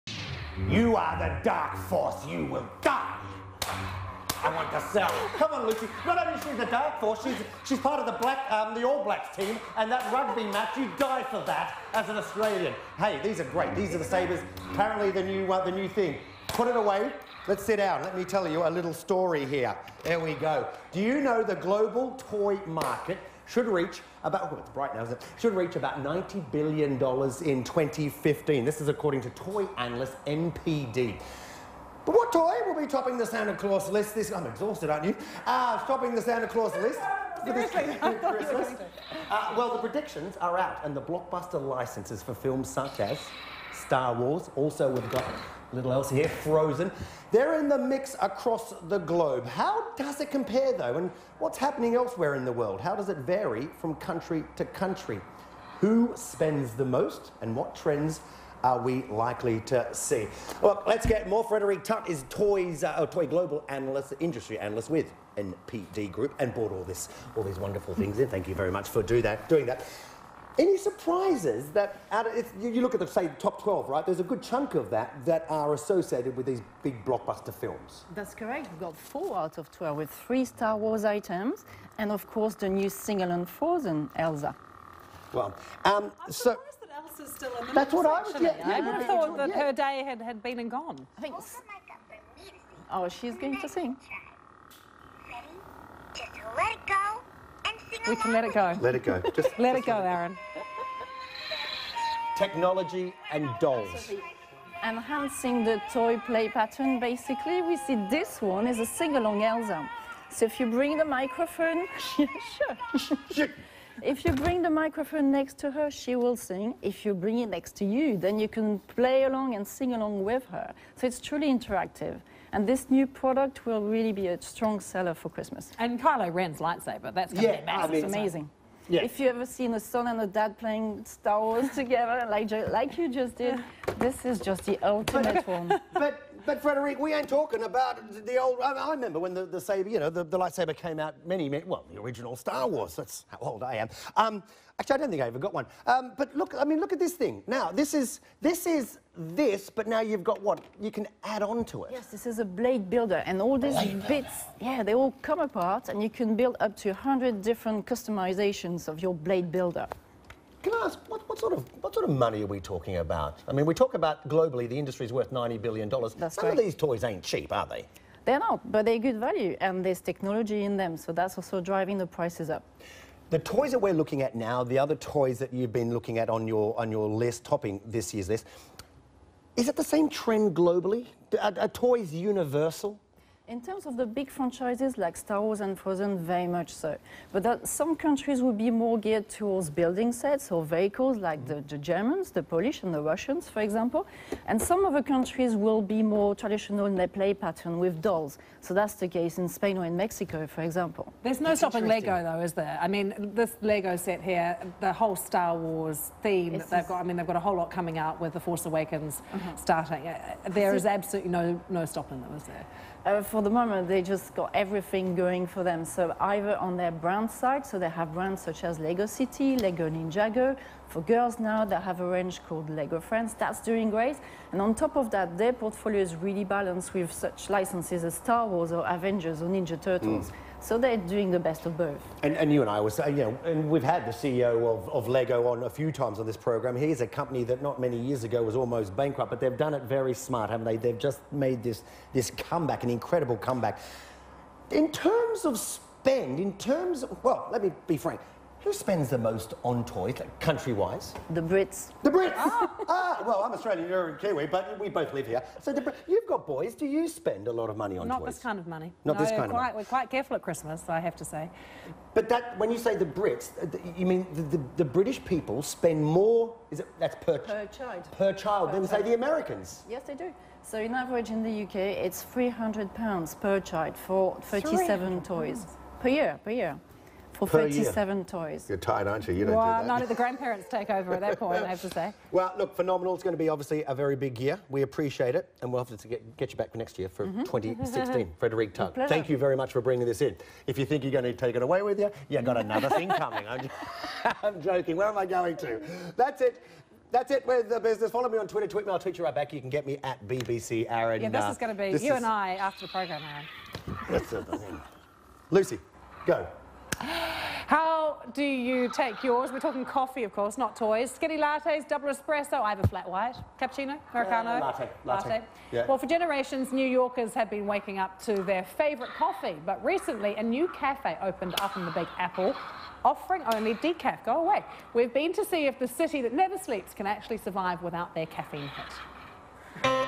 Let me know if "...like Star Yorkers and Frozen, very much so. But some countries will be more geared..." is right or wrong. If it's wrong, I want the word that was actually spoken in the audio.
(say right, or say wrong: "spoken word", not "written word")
wrong: "Wars", not "Yorkers".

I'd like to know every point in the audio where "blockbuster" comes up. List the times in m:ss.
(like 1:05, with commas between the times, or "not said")
0:41, 1:17.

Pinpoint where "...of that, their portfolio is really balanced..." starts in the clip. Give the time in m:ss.
3:44.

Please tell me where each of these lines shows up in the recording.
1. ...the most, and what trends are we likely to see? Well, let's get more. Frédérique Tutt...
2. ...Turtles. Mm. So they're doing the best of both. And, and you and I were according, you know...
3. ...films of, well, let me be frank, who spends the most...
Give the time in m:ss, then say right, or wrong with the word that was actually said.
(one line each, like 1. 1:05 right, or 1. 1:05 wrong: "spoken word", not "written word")
1. 0:56 right
2. 3:49 wrong: "saying", not "according"
3. 4:06 wrong: "terms", not "films".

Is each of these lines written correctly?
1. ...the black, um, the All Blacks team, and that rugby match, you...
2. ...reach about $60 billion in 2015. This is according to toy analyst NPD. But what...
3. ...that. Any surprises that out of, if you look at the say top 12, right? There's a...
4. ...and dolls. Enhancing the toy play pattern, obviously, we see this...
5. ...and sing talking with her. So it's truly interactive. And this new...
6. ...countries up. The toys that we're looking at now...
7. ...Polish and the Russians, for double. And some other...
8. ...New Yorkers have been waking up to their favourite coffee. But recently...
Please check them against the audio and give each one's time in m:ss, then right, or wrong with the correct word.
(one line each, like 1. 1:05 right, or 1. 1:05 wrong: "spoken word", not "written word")
1. 0:08 right
2. 0:25 wrong: "90", not "60"
3. 1:09 right
4. 1:43 wrong: "basically", not "obviously"
5. 1:59 wrong: "along", not "talking"
6. 2:52 wrong: "prices", not "countries"
7. 3:12 wrong: "example", not "double"
8. 5:16 right.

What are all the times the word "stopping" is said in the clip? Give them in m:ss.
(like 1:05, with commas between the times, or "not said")
3:21, 3:31.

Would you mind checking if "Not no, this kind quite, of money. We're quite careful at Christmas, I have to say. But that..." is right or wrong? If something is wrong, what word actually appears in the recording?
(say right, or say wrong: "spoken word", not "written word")
right.